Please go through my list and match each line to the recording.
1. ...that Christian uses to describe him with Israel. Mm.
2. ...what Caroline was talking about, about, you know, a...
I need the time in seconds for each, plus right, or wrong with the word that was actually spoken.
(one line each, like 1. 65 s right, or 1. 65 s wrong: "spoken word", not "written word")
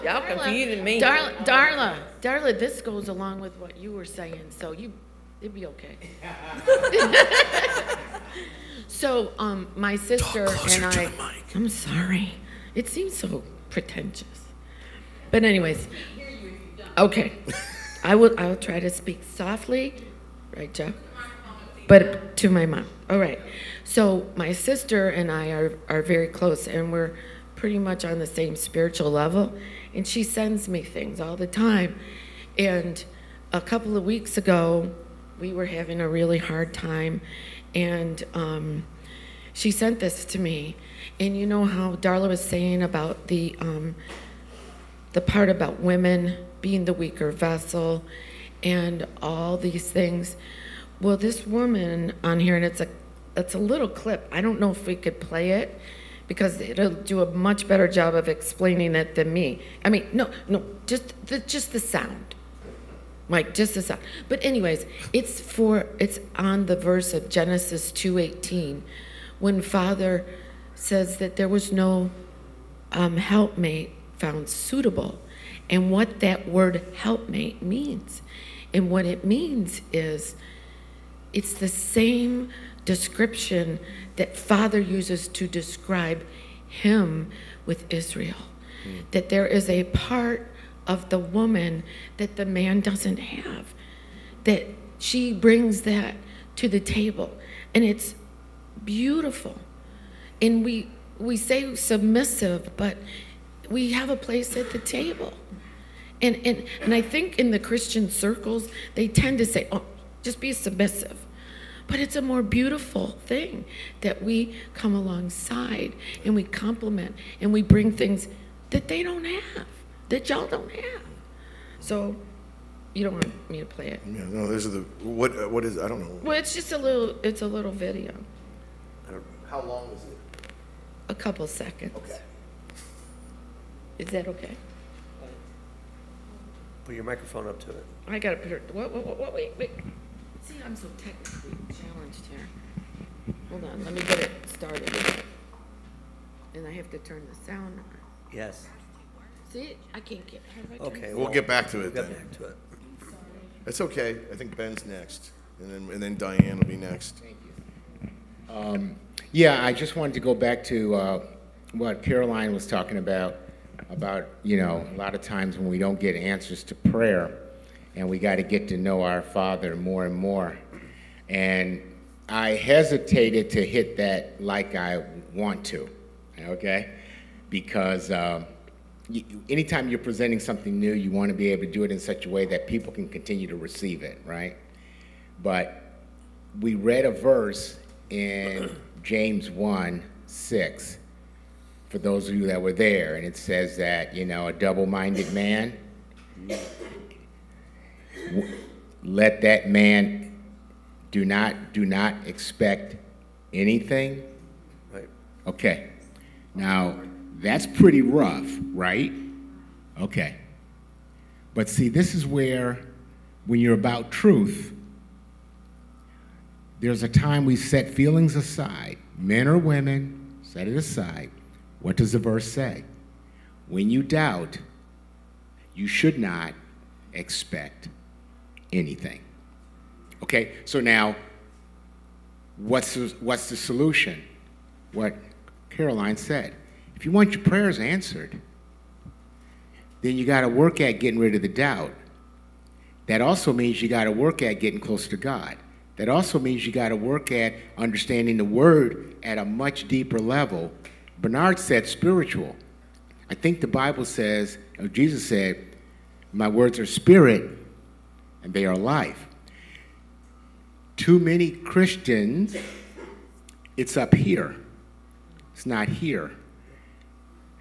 1. 84 s wrong: "Father", not "Christian"
2. 161 s right.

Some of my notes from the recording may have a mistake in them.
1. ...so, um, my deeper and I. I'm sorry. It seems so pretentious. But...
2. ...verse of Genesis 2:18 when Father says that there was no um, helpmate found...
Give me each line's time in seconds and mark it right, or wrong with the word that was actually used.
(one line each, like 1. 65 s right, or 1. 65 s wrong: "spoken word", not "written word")
1. 8 s wrong: "sister", not "deeper"
2. 66 s right.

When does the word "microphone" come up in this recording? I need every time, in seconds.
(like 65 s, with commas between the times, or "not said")
137 s.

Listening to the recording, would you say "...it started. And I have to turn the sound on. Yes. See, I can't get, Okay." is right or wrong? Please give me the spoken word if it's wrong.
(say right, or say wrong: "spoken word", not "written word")
right.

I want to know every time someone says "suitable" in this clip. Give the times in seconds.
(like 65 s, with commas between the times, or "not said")
74 s.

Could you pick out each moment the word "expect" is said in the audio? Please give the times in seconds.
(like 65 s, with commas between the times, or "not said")
202 s, 227 s.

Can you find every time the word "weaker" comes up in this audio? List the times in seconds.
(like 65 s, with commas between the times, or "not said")
46 s.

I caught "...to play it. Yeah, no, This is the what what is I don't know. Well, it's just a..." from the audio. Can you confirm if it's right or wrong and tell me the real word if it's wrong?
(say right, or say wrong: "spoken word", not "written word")
right.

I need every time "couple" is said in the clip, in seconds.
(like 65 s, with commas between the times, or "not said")
33 s, 131 s.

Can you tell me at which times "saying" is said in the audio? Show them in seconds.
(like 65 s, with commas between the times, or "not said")
4 s, 42 s.